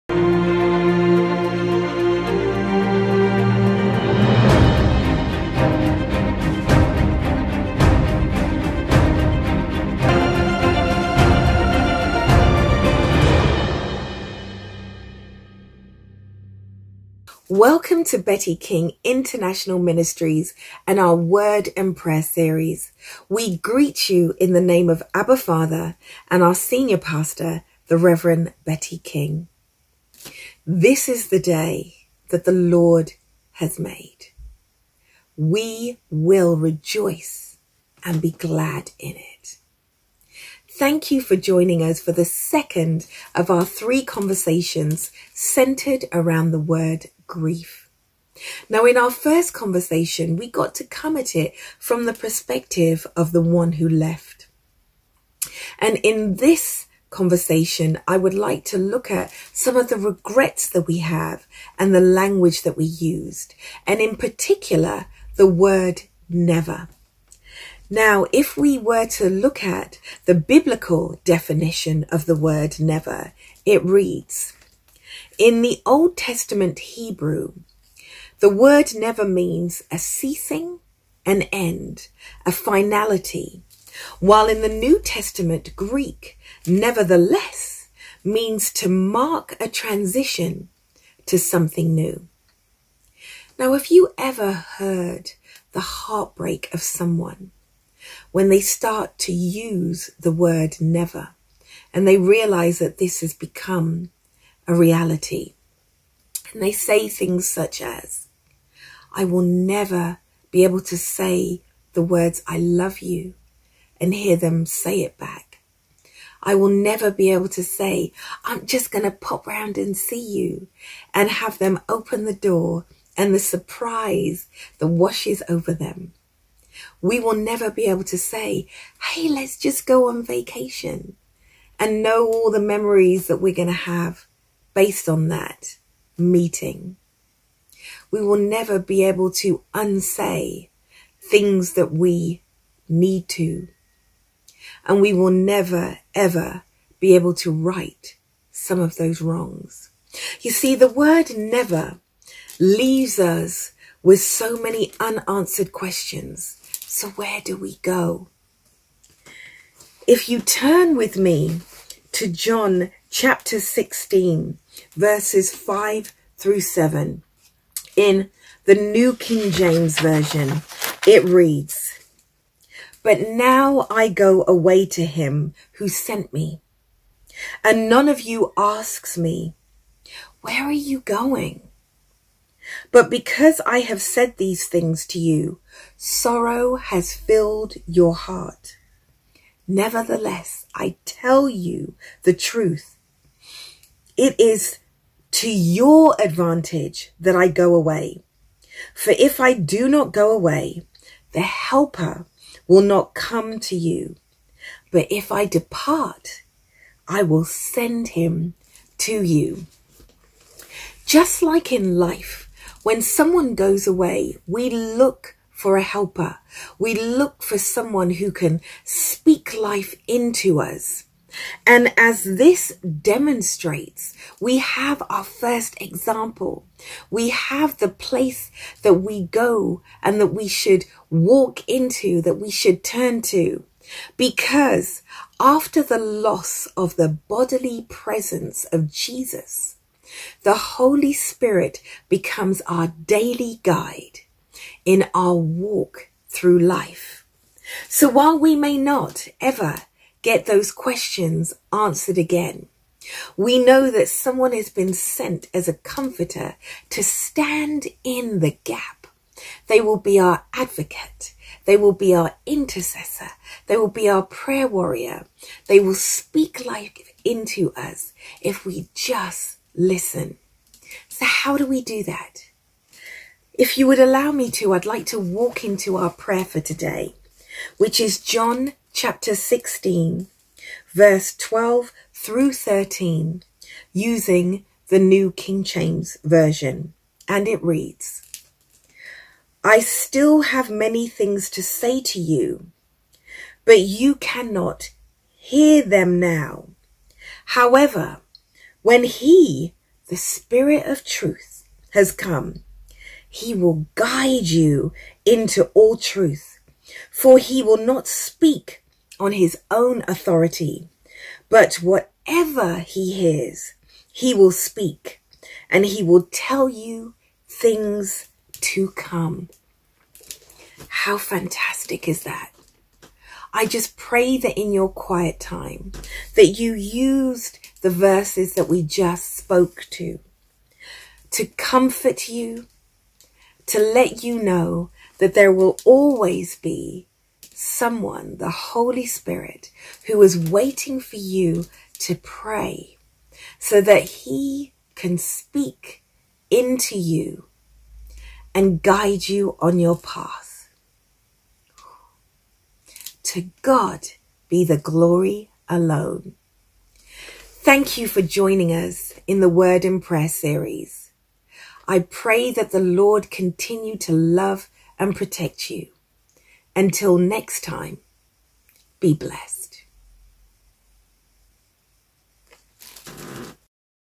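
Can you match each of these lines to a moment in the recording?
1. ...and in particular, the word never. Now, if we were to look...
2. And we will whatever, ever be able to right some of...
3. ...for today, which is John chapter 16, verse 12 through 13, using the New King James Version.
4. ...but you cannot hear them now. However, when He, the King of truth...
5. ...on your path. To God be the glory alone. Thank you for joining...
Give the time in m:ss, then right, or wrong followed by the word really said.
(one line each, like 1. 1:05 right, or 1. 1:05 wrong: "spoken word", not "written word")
1. 1:03 right
2. 2:24 wrong: "never", not "whatever"
3. 4:36 right
4. 4:53 wrong: "Spirit", not "King"
5. 5:49 right.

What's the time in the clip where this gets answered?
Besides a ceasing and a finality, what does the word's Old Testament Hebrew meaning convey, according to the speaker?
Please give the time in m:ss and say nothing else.
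1:21.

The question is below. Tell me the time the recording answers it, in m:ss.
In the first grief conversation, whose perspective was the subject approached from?
0:53.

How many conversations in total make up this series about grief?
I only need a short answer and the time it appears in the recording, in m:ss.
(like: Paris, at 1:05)
3, at 0:43.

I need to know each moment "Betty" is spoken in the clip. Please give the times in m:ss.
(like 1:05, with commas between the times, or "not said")
0:18, 0:28.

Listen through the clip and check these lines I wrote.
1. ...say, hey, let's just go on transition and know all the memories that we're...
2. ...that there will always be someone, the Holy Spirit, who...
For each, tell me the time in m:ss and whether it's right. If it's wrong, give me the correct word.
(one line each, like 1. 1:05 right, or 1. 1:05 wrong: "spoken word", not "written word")
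1. 2:08 wrong: "vacation", not "transition"
2. 5:35 right.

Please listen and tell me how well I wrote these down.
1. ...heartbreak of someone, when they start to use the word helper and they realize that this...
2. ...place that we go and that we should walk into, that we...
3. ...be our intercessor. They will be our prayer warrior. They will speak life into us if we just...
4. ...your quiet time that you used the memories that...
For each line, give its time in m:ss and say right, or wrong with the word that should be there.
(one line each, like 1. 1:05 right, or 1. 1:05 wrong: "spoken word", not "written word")
1. 1:36 wrong: "never", not "helper"
2. 3:47 right
3. 4:21 right
4. 5:24 wrong: "verses", not "memories".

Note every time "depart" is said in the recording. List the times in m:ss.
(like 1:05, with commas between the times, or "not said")
3:25.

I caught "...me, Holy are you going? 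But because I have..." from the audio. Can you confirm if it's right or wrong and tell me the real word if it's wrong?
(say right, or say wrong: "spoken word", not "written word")
wrong: "Where", not "Holy".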